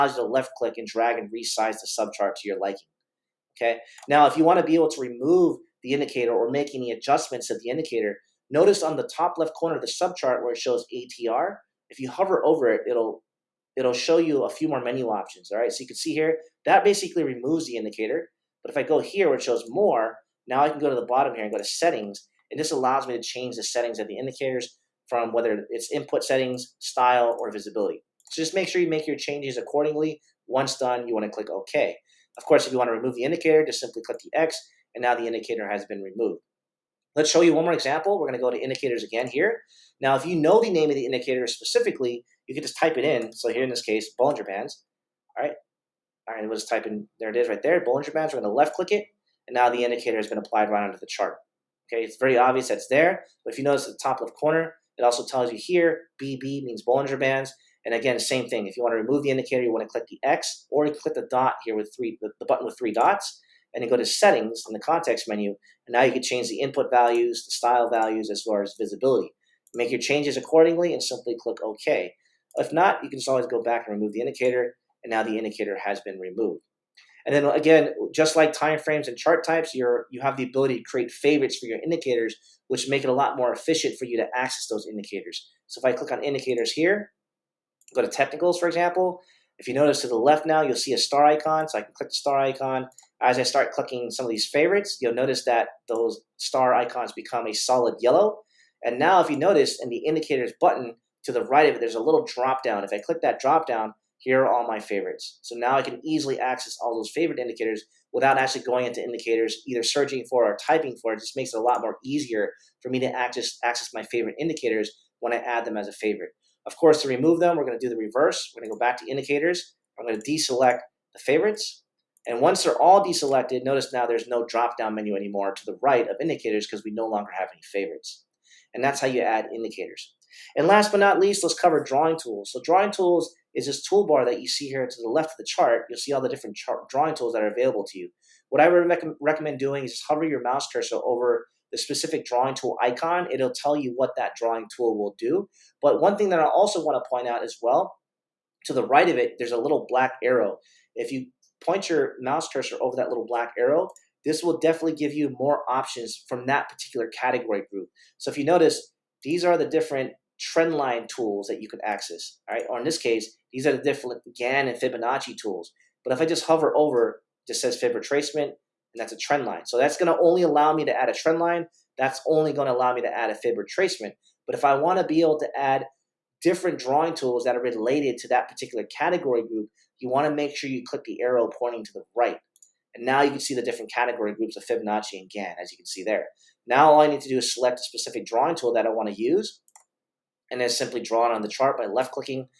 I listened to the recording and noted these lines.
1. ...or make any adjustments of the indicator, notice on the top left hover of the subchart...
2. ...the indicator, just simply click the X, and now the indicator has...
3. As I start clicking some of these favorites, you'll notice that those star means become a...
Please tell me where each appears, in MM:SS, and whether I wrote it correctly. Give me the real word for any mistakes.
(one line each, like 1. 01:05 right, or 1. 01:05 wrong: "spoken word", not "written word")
1. 00:06 wrong: "corner", not "hover"
2. 00:33 right
3. 01:33 wrong: "icons", not "means".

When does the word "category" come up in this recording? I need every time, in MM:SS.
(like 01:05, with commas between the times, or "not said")
02:37, 02:58, 03:03.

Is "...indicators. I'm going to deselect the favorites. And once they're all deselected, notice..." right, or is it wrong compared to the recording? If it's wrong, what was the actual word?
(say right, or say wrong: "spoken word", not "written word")
right.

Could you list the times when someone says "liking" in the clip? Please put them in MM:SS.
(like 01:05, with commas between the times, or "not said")
00:02.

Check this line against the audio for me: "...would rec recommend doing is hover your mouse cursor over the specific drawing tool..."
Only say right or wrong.
right.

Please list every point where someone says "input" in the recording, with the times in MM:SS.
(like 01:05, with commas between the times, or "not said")
00:25, 01:06.